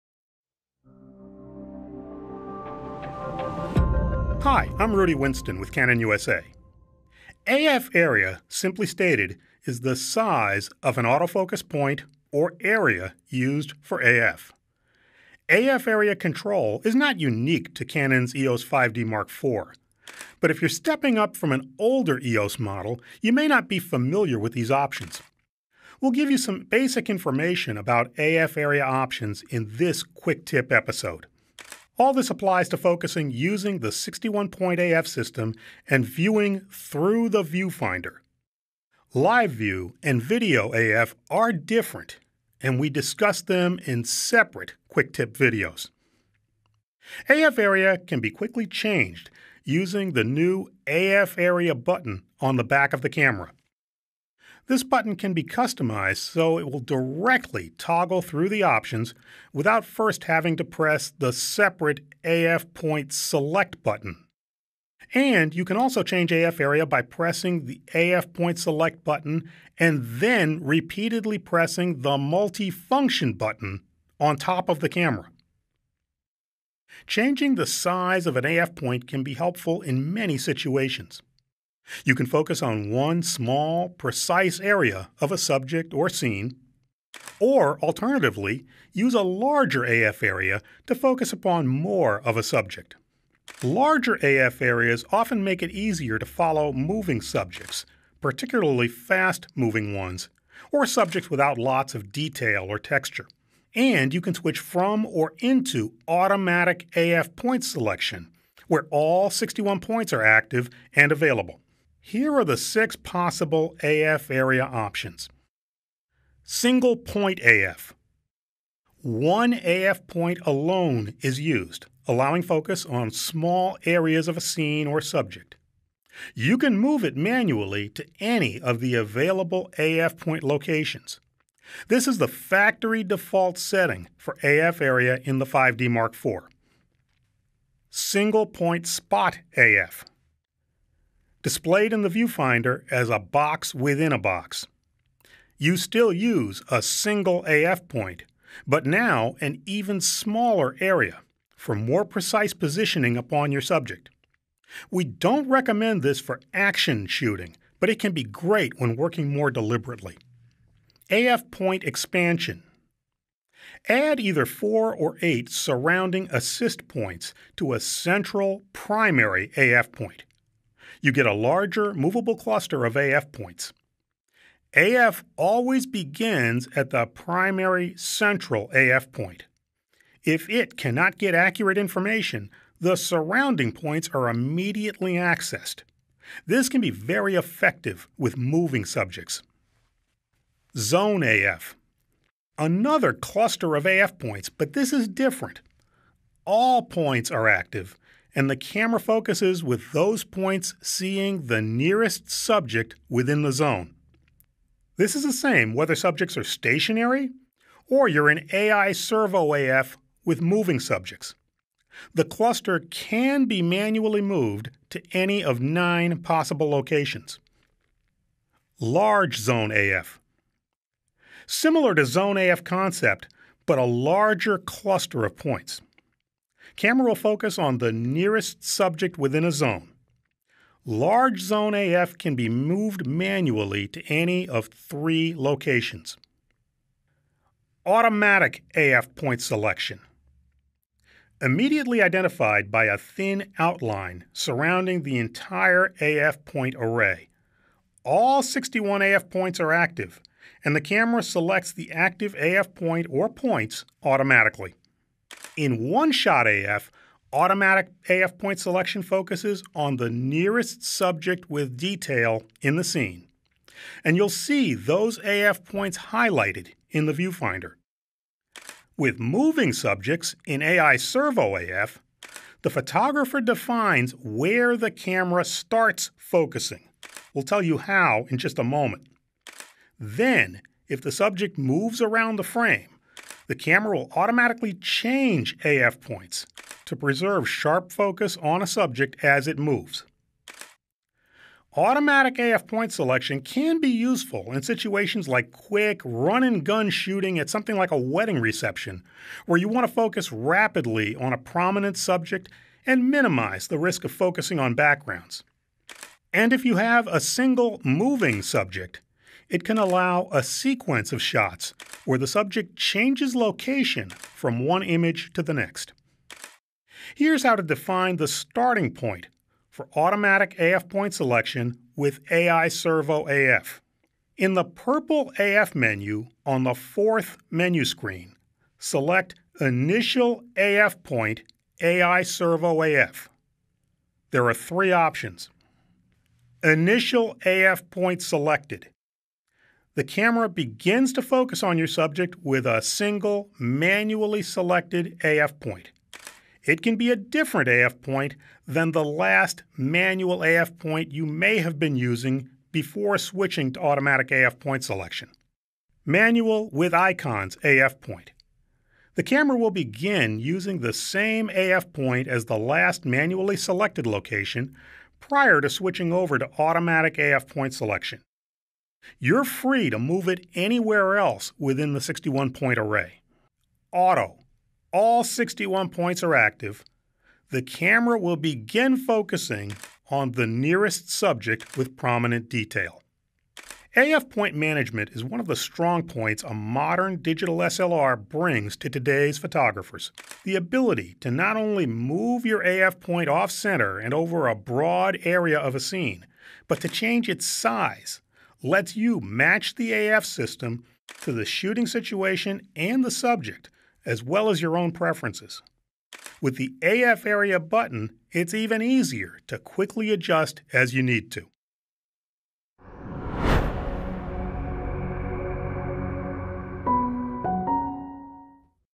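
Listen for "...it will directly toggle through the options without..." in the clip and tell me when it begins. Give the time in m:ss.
0:56.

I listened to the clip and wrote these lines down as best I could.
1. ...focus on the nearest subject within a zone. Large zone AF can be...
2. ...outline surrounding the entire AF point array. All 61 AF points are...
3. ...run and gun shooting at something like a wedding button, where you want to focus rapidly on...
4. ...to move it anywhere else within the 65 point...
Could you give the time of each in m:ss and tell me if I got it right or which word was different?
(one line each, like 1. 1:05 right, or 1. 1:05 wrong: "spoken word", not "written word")
1. 3:47 right
2. 4:03 right
3. 4:56 wrong: "reception", not "button"
4. 6:09 wrong: "61", not "65".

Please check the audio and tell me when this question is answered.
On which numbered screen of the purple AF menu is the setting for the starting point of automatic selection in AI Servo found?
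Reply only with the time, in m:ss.
5:26.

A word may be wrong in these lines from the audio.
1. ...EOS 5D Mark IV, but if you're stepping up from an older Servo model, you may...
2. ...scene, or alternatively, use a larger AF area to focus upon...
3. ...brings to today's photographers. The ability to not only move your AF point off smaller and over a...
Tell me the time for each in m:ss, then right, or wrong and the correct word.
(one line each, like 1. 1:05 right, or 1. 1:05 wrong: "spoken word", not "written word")
1. 0:18 wrong: "EOS", not "Servo"
2. 1:26 right
3. 6:28 wrong: "center", not "smaller".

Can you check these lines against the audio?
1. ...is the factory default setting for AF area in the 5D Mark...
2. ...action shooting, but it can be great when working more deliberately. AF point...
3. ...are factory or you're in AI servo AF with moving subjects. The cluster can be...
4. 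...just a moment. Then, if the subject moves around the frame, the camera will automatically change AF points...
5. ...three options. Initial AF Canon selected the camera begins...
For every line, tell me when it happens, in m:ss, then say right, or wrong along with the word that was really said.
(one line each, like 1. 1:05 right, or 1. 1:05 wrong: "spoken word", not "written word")
1. 2:12 right
2. 2:36 right
3. 3:26 wrong: "stationary", not "factory"
4. 4:38 right
5. 5:34 wrong: "Point", not "Canon".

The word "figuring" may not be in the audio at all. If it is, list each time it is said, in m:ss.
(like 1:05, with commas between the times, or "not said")
not said.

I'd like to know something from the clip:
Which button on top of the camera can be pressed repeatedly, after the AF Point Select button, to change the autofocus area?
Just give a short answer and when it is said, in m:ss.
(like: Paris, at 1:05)
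Multifunction button, at 1:12.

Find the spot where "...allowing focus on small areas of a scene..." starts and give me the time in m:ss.
2:02.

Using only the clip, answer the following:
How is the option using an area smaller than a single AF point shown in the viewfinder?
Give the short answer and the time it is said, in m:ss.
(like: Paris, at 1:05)
box within a box, at 2:23.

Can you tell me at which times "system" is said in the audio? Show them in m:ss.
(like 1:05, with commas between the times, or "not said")
0:35, 6:40.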